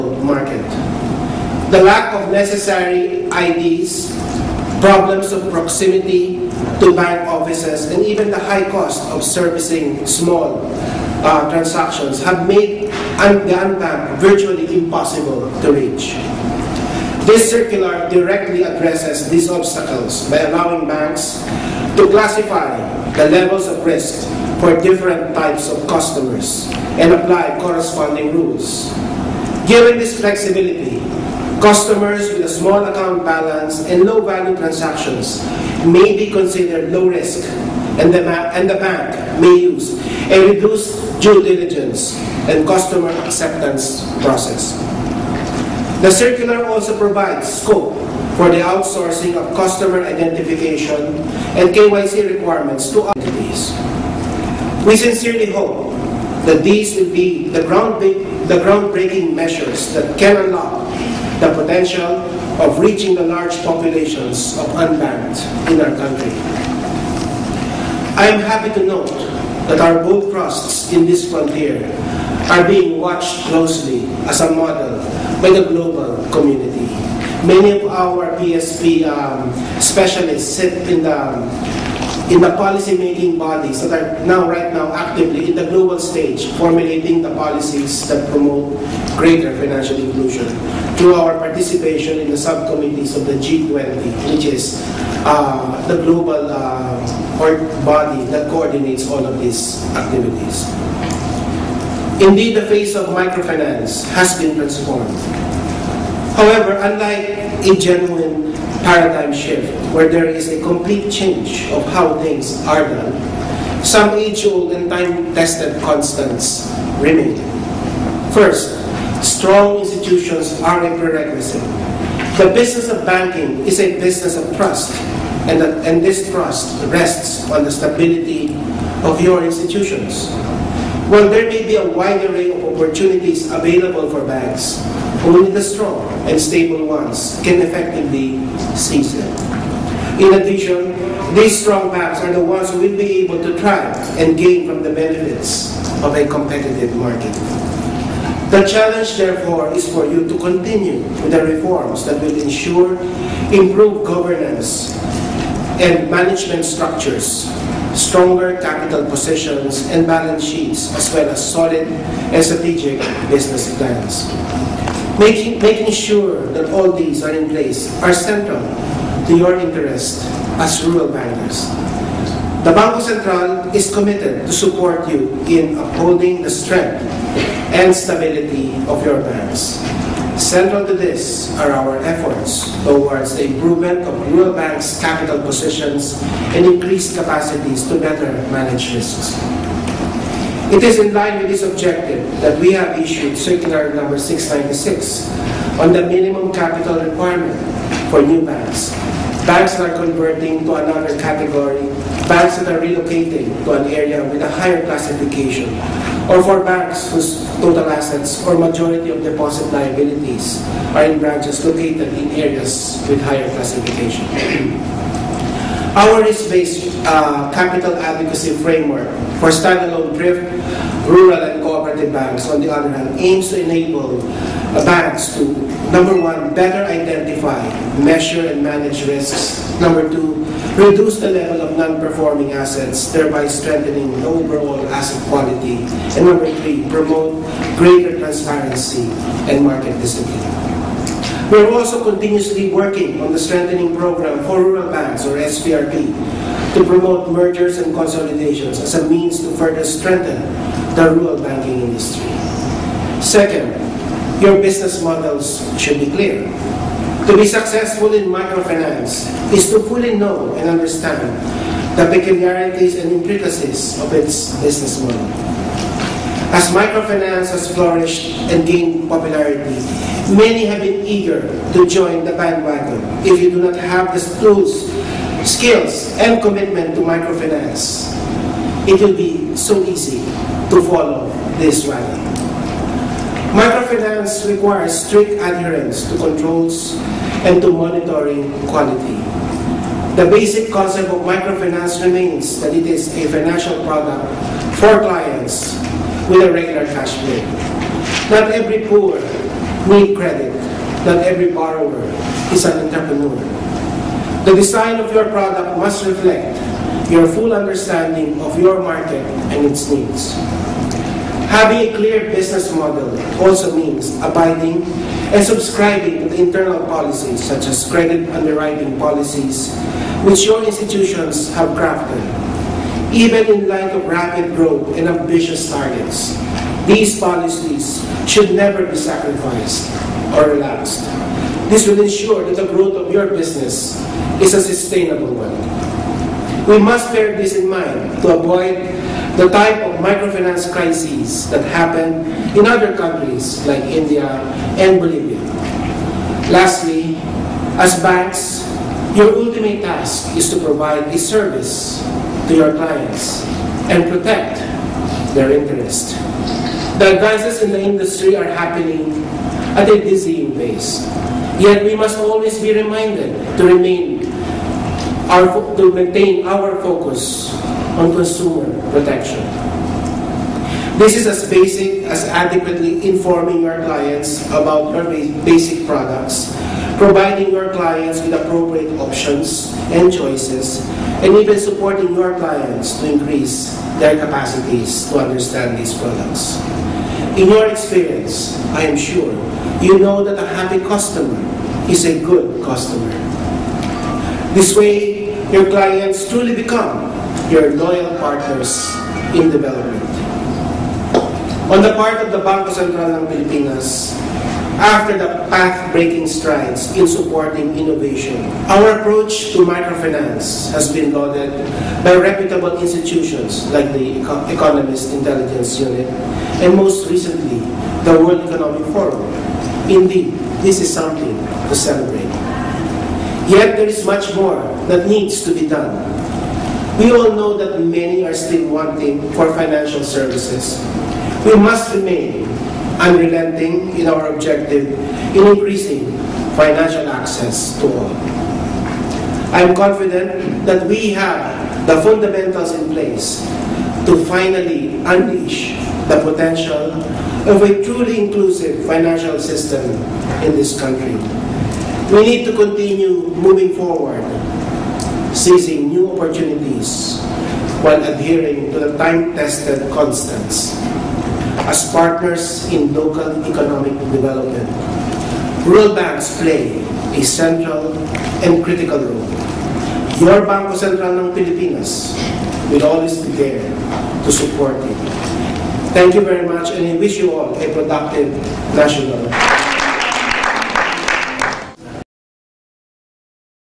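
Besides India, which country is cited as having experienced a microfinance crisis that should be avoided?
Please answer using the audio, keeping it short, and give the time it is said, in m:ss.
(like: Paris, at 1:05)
Bolivia, at 5:44.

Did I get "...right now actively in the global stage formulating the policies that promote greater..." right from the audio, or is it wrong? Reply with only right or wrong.
right.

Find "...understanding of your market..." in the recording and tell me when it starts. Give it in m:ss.
5:07.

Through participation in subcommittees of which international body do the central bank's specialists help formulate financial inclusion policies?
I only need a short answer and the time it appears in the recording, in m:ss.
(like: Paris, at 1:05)
G20, at 1:33.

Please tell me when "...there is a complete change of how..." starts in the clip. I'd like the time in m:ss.
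1:50.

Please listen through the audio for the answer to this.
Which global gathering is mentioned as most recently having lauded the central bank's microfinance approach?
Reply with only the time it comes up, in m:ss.
6:58.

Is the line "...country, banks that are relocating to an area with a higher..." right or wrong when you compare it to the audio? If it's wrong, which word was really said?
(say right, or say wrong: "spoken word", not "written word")
wrong: "category", not "country".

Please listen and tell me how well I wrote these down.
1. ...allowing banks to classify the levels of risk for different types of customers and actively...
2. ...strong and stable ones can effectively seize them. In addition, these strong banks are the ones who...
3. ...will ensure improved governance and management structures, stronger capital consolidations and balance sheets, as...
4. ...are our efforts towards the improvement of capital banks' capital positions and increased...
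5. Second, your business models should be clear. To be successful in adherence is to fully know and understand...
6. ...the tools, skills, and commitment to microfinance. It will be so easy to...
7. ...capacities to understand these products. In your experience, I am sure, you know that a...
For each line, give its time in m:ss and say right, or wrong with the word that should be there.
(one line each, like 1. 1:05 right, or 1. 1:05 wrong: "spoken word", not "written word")
1. 0:20 wrong: "apply", not "actively"
2. 2:15 right
3. 2:32 wrong: "positions", not "consolidations"
4. 3:01 wrong: "rural", not "capital"
5. 4:13 wrong: "microfinance", not "adherence"
6. 4:34 right
7. 6:24 right.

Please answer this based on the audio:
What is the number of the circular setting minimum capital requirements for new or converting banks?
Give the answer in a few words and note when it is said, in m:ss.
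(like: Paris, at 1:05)
696, at 3:14.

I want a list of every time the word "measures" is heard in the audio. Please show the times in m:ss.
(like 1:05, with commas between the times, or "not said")
0:59, 3:47.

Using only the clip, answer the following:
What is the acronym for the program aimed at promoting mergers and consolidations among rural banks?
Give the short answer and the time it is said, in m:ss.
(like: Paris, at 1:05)
SPRB, at 4:05.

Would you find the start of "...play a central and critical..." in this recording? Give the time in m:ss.
7:46.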